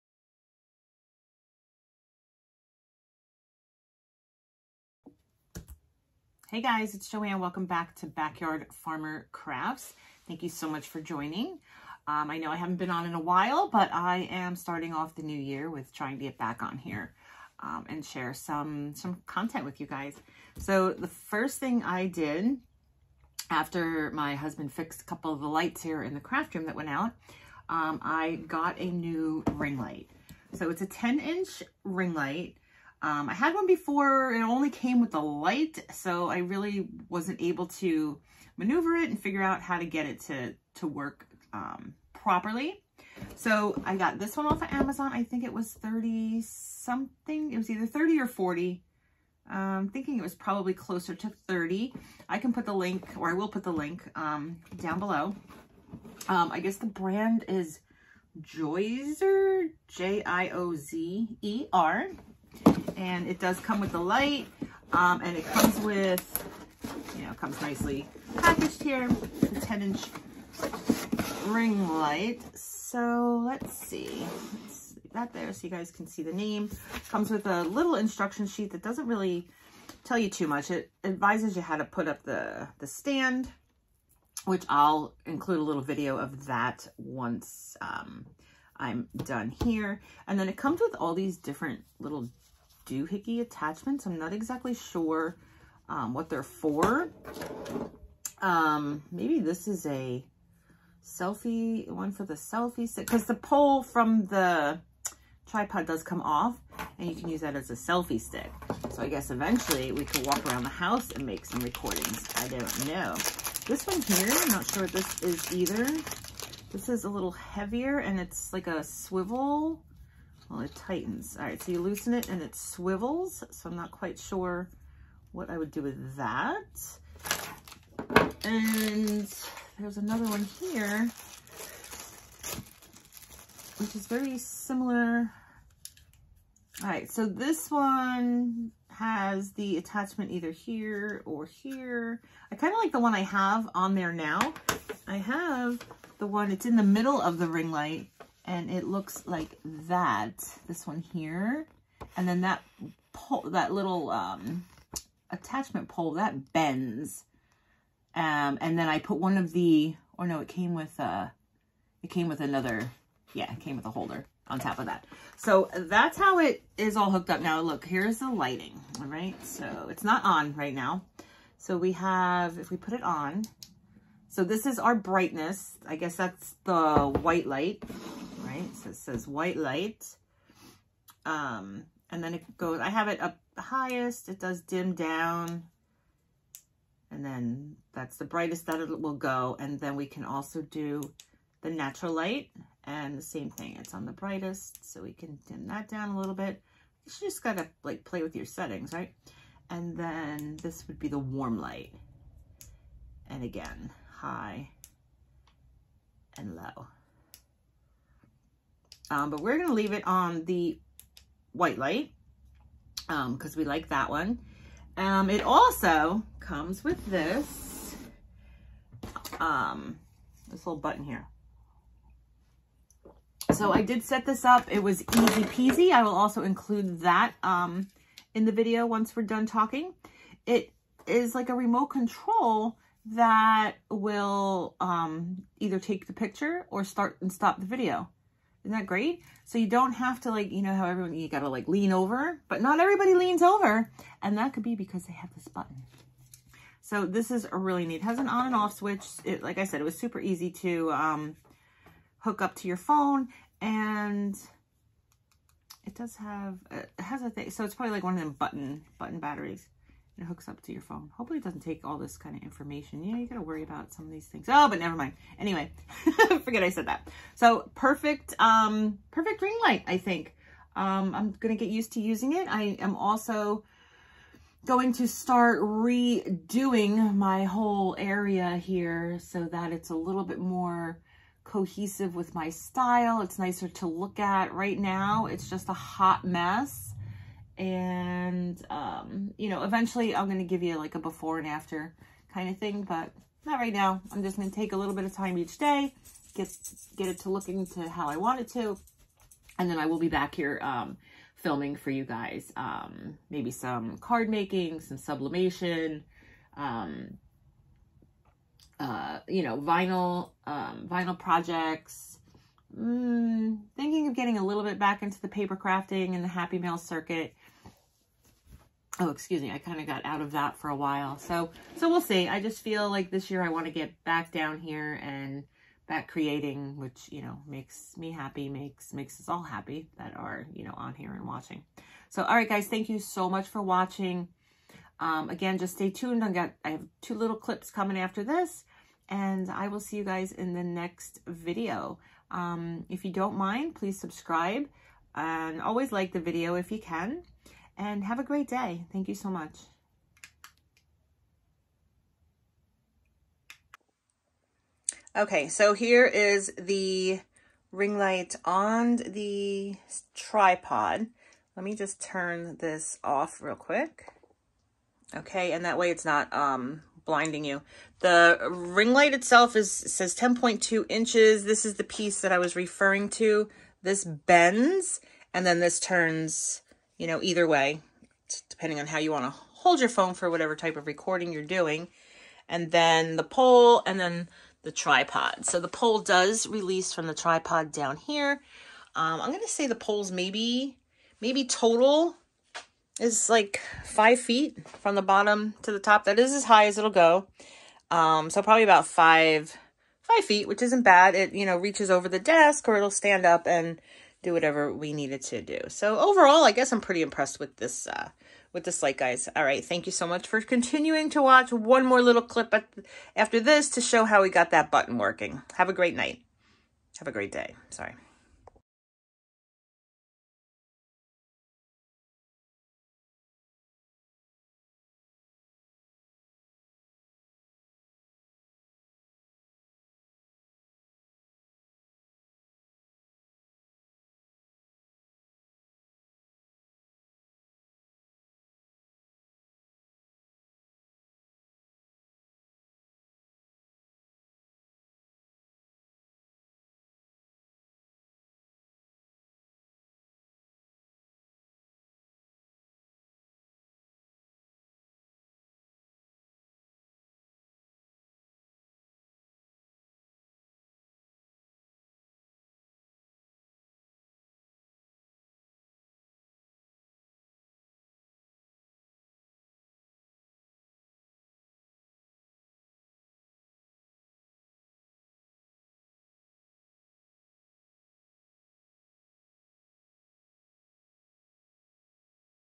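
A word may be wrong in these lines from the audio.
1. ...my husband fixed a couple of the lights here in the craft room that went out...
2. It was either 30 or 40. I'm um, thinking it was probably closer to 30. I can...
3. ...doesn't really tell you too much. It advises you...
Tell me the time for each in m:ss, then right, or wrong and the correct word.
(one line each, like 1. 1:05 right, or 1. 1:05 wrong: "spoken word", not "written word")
1. 0:24 right
2. 0:47 right
3. 1:18 right.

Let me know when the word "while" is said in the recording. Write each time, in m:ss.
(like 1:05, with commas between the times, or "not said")
0:13, 5:20.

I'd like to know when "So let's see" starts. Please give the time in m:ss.
1:12.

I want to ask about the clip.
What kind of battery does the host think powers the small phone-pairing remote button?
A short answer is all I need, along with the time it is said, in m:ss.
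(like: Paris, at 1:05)
button batteries, at 4:18.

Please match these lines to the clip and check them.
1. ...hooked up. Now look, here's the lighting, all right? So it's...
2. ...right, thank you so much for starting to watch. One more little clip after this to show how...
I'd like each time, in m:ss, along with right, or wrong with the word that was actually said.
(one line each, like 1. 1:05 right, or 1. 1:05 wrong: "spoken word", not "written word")
1. 2:47 right
2. 6:49 wrong: "continuing", not "starting".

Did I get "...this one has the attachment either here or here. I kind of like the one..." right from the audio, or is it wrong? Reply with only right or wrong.
right.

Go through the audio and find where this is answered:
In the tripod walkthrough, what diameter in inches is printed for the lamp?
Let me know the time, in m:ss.
6:10.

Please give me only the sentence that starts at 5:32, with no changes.
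So, all right, guys, thank you so much for watching.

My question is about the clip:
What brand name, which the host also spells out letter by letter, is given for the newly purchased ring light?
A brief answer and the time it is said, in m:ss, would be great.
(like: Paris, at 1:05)
Joyzer, at 0:58.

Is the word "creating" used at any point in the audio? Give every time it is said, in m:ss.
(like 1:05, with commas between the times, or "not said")
5:26.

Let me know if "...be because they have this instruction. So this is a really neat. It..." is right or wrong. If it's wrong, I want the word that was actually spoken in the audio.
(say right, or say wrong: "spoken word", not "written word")
wrong: "button", not "instruction".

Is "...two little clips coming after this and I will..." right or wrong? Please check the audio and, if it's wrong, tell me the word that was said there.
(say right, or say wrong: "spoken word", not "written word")
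right.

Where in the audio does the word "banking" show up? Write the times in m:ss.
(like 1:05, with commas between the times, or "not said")
not said.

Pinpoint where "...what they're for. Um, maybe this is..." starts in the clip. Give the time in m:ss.
1:36.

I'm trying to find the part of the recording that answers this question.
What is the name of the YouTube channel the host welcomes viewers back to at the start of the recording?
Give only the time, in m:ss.
0:08.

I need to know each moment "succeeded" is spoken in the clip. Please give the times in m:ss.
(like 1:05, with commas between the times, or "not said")
not said.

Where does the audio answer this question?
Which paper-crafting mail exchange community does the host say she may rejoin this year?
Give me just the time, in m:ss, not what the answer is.
5:16.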